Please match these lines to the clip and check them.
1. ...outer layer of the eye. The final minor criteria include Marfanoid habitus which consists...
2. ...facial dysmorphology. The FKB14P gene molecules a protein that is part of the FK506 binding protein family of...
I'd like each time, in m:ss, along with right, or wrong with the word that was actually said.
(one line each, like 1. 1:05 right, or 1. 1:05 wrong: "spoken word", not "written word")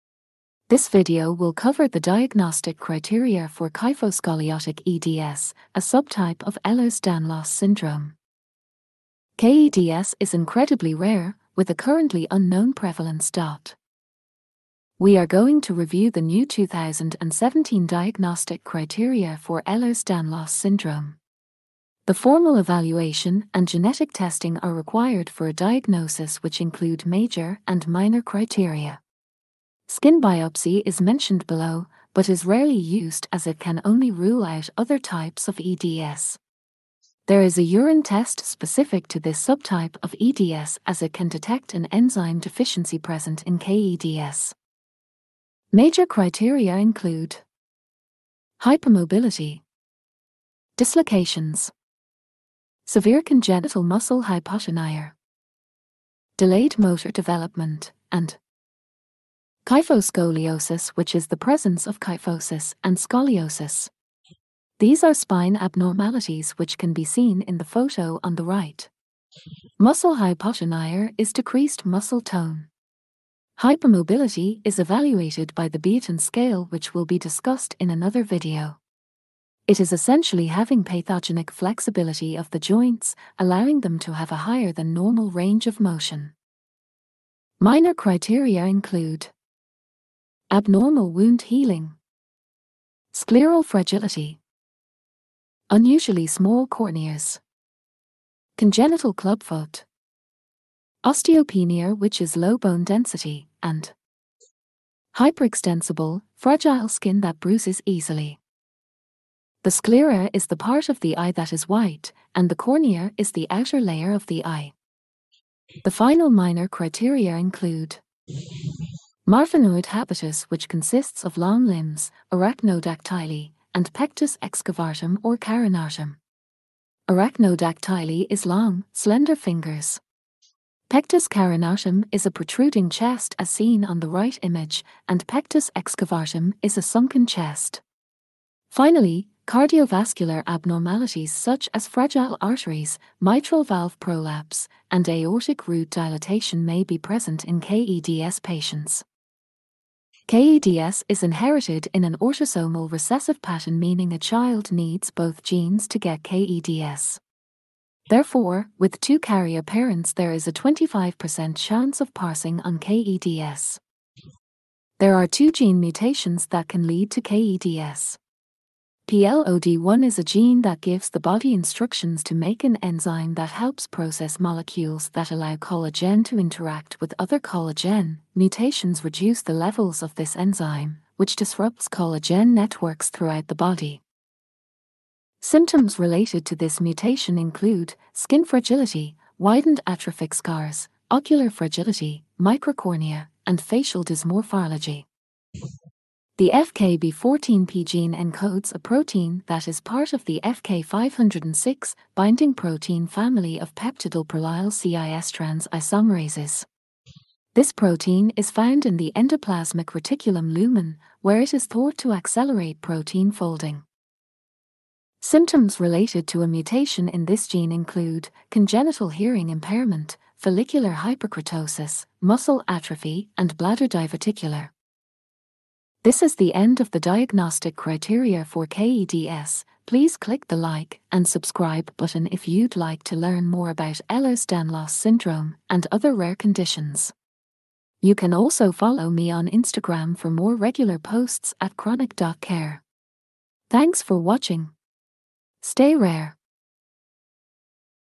1. 1:53 right
2. 3:13 wrong: "encodes", not "molecules".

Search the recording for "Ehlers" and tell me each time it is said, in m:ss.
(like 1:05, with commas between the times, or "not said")
0:06, 0:19, 3:54.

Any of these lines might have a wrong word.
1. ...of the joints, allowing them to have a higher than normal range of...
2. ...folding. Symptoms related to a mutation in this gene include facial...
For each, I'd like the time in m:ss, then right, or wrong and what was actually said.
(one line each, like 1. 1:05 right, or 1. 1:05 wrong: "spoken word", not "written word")
1. 1:22 right
2. 3:33 wrong: "congenital", not "facial".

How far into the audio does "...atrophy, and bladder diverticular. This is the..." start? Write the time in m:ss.
3:42.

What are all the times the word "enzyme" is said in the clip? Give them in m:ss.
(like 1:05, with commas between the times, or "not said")
0:41, 2:52, 3:00.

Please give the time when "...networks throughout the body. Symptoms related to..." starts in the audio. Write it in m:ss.
3:02.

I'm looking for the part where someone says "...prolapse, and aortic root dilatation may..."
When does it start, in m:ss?
2:24.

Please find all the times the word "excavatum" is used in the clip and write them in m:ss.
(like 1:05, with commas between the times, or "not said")
2:04, 2:15.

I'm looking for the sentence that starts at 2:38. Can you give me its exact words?
Therefore, with two carrier parents there is a 25% chance of passing on KEDS.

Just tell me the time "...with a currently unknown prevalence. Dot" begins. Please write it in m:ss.
0:11.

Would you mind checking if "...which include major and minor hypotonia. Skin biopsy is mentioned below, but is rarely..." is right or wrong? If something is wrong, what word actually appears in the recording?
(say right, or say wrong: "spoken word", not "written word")
wrong: "criteria", not "hypotonia".